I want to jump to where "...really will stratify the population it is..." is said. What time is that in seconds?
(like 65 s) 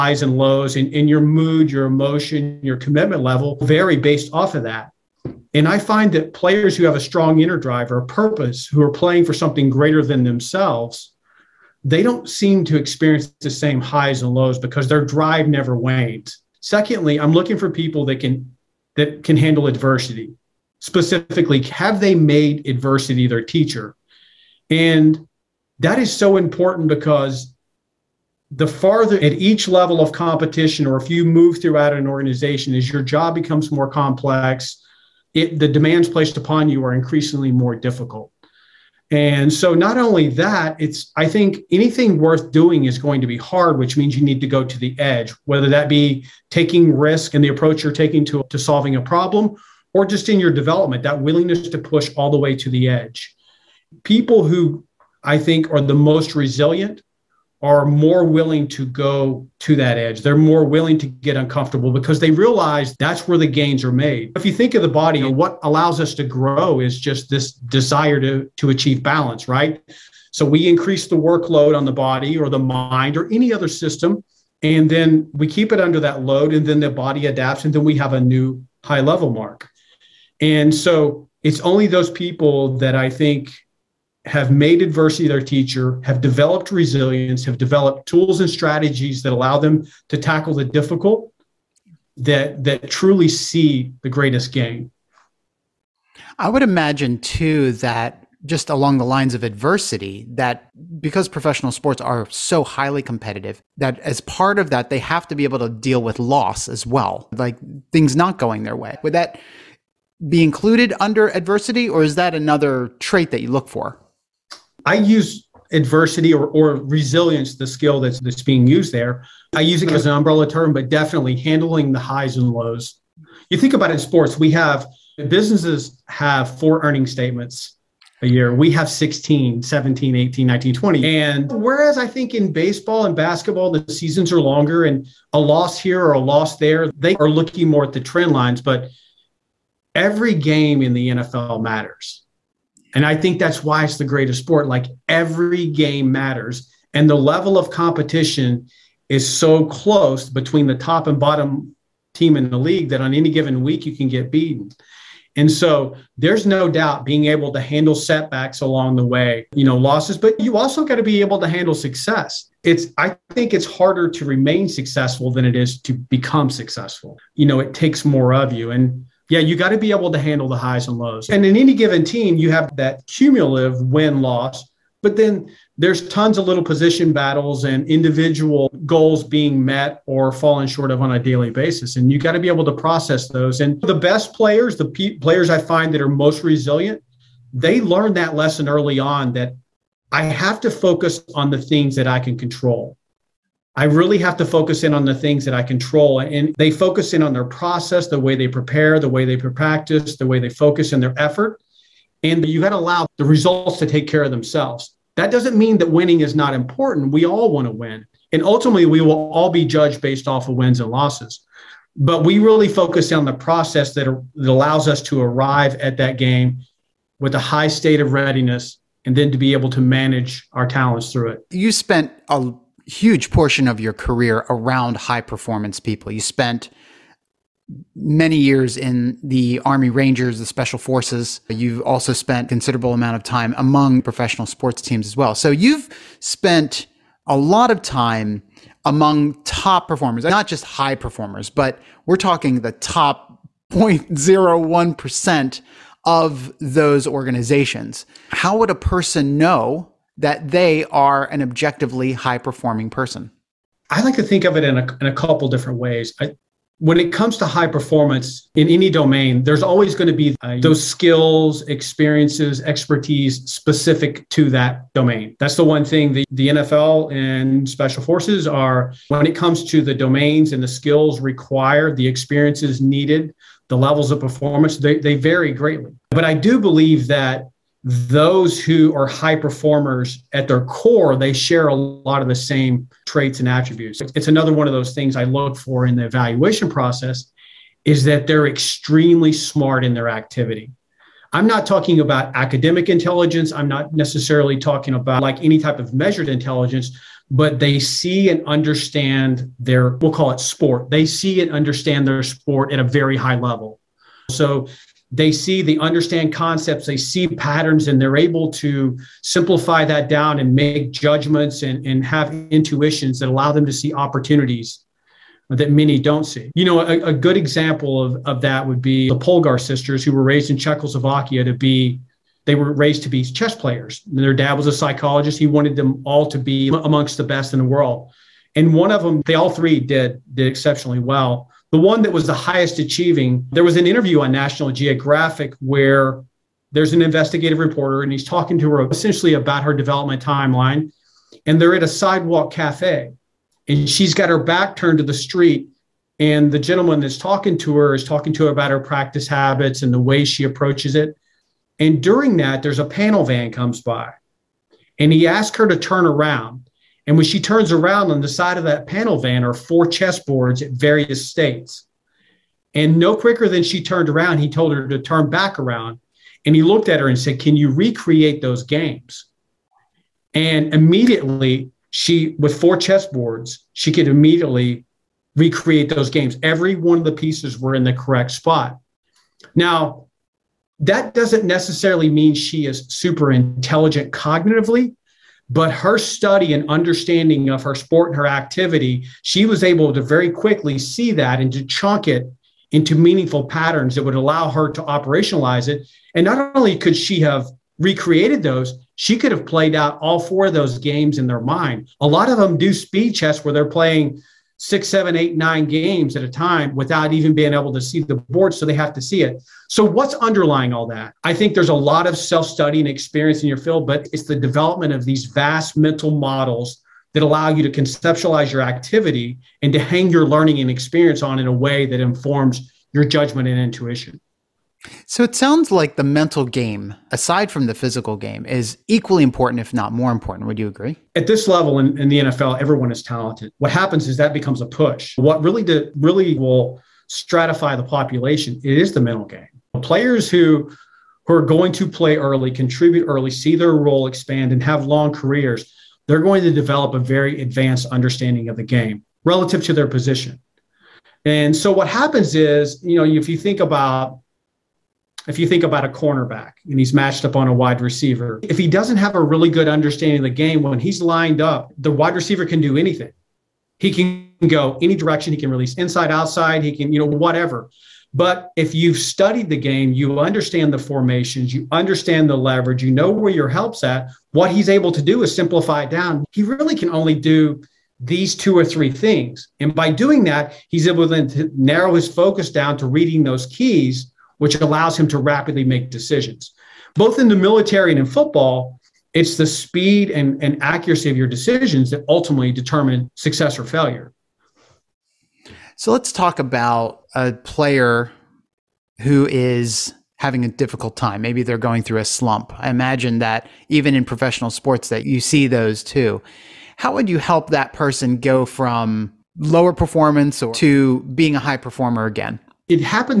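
435 s.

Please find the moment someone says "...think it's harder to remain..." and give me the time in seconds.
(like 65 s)
163 s.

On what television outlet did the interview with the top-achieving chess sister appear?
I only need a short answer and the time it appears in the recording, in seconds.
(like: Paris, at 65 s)
National Geographic, at 334 s.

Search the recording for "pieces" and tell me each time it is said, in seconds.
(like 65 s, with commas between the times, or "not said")
377 s.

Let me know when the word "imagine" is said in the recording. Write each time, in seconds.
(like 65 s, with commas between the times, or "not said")
96 s, 502 s.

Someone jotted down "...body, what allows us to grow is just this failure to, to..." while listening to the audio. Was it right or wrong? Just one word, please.
wrong.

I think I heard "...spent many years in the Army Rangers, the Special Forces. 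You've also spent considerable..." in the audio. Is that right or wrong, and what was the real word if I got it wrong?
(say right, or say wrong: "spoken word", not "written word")
right.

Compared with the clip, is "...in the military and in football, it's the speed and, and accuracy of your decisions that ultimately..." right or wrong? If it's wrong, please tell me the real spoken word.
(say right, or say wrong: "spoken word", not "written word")
right.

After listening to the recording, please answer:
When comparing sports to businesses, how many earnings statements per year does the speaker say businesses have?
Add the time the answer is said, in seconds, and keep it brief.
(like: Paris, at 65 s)
4, at 126 s.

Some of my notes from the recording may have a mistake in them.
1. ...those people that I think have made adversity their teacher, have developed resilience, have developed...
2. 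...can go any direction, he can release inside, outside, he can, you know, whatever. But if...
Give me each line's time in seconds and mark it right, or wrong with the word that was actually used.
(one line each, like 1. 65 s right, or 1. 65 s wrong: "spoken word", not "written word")
1. 81 s right
2. 463 s right.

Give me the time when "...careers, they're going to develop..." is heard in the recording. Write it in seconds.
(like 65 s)
445 s.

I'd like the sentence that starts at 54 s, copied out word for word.
People who I think are the most resilient are more willing to go to that edge.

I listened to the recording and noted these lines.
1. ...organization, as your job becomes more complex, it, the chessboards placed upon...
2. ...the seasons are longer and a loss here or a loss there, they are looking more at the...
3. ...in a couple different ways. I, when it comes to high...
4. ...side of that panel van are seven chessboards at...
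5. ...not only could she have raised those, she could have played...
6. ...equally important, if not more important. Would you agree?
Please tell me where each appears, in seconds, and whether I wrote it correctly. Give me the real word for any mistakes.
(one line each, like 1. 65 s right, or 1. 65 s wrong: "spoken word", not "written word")
1. 32 s wrong: "demands", not "chessboards"
2. 133 s right
3. 254 s right
4. 358 s wrong: "four", not "seven"
5. 396 s wrong: "recreated", not "raised"
6. 428 s right.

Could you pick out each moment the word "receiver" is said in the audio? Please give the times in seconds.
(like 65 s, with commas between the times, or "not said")
457 s, 462 s.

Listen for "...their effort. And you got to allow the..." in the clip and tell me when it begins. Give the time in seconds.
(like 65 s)
201 s.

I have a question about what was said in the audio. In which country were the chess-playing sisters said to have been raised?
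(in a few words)
Czechoslovakia.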